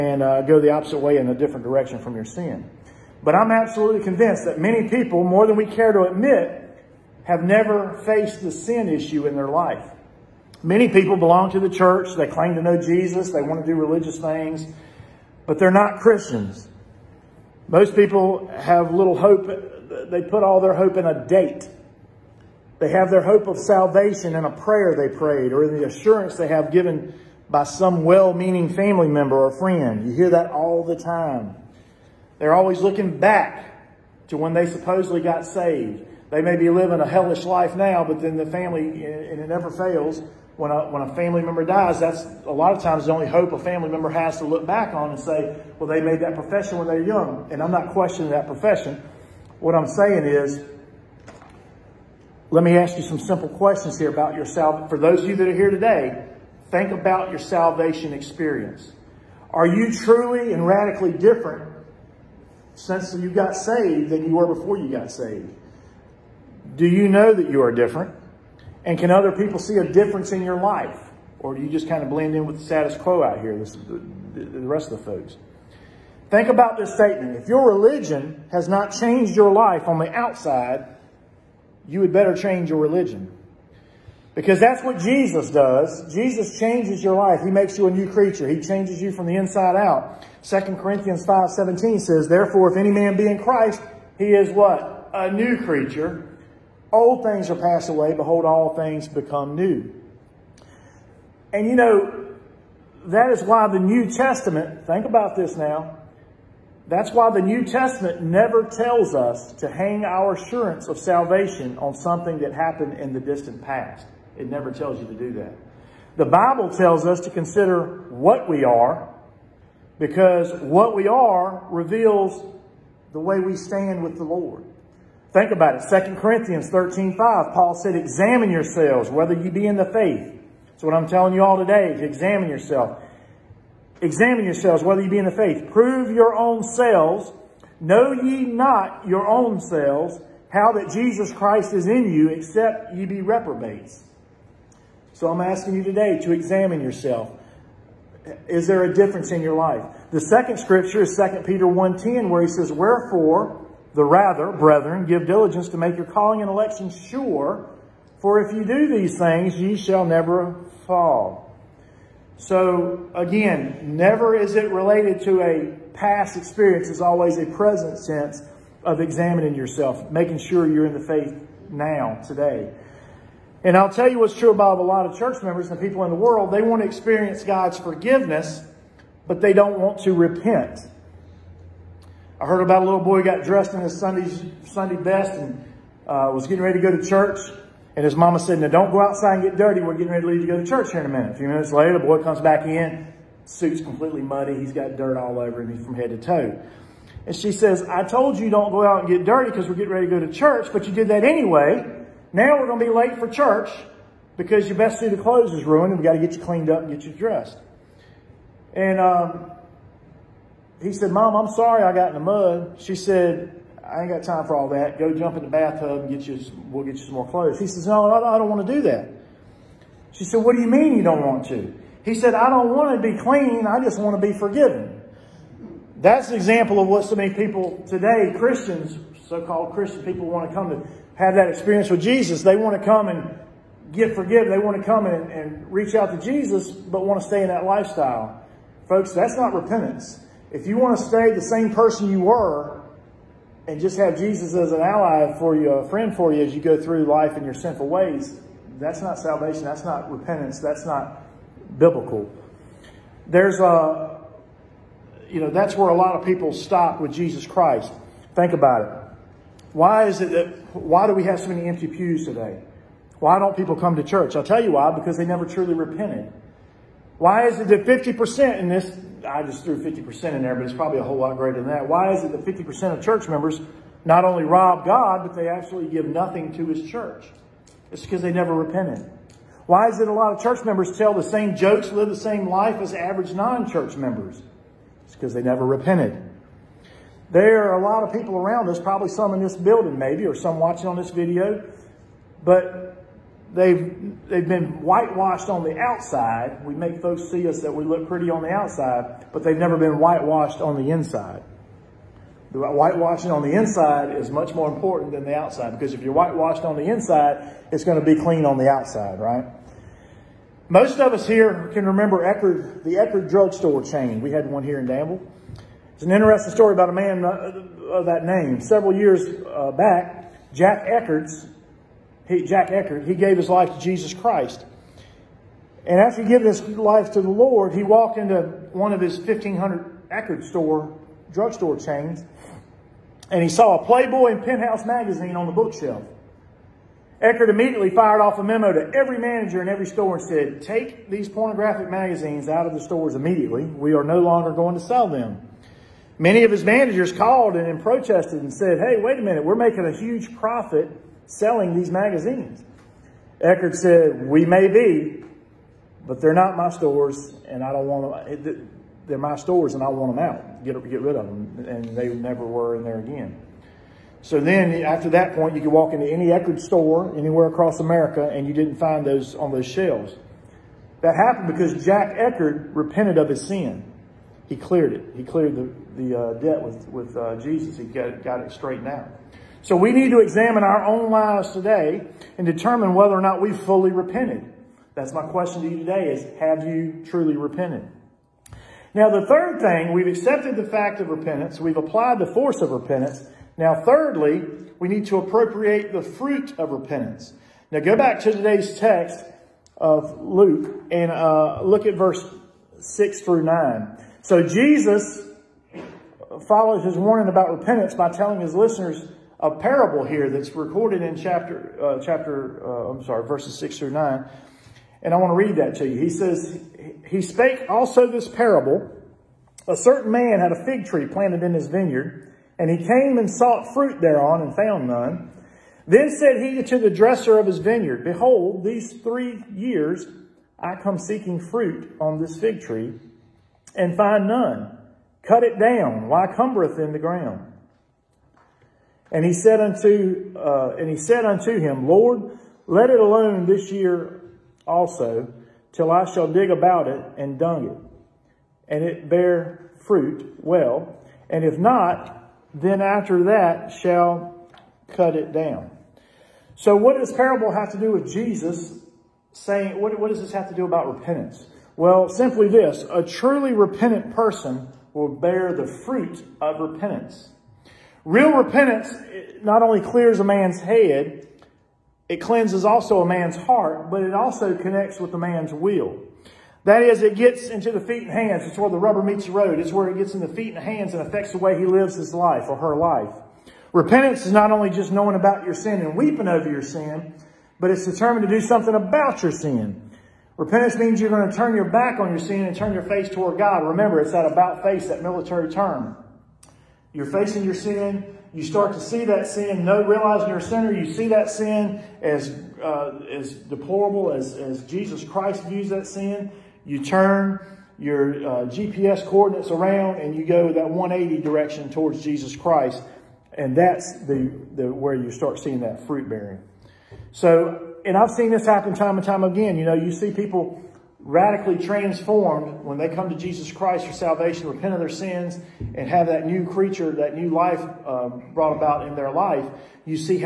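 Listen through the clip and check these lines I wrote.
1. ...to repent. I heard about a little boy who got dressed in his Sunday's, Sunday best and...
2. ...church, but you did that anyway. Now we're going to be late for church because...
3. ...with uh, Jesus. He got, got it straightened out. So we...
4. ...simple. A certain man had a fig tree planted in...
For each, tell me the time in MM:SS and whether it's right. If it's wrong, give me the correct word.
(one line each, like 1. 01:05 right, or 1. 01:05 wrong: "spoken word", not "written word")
1. 03:00 right
2. 03:20 right
3. 06:16 right
4. 06:58 wrong: "parable", not "simple".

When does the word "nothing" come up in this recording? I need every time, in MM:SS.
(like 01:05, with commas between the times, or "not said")
04:36.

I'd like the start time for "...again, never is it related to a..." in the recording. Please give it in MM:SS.
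02:43.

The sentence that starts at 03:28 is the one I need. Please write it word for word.
And um, he said, Mom, I'm sorry I got in the mud.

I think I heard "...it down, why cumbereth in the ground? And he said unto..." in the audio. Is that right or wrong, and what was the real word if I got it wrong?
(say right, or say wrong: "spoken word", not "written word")
right.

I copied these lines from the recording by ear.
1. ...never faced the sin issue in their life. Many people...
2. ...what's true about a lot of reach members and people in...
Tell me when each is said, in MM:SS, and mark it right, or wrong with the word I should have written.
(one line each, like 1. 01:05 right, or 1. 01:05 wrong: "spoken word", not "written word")
1. 00:07 right
2. 02:54 wrong: "church", not "reach".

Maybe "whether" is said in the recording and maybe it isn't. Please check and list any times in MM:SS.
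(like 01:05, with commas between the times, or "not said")
02:09, 02:14, 06:22.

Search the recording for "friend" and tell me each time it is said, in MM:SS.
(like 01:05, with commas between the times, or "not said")
00:29, 04:05.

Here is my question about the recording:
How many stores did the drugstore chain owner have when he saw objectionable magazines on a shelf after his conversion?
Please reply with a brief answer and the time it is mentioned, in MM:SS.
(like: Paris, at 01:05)
1,500, at 05:29.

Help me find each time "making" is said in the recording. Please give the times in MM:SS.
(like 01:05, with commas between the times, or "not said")
02:50, 05:49.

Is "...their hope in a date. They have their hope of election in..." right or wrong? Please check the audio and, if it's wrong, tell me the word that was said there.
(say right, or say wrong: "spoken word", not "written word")
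wrong: "salvation", not "election".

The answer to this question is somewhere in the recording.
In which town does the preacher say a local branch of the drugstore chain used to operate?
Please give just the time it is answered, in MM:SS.
05:14.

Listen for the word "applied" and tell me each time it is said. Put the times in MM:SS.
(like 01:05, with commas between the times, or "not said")
06:31.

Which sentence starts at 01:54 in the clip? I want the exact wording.
It never tells you to do that.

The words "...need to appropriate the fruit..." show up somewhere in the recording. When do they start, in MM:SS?
06:34.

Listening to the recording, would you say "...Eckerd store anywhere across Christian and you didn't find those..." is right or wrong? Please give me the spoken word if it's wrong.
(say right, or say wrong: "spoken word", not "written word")
wrong: "America", not "Christian".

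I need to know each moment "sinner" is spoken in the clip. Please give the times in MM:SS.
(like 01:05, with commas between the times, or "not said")
08:20.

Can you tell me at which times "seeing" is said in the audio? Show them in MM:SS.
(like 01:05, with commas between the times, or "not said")
08:35.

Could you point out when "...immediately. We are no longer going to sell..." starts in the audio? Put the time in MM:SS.
05:43.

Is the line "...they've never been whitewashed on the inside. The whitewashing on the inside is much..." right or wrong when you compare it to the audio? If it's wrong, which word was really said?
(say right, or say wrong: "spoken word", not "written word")
right.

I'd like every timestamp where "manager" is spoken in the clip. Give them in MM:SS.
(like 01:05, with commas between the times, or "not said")
05:39, 05:46.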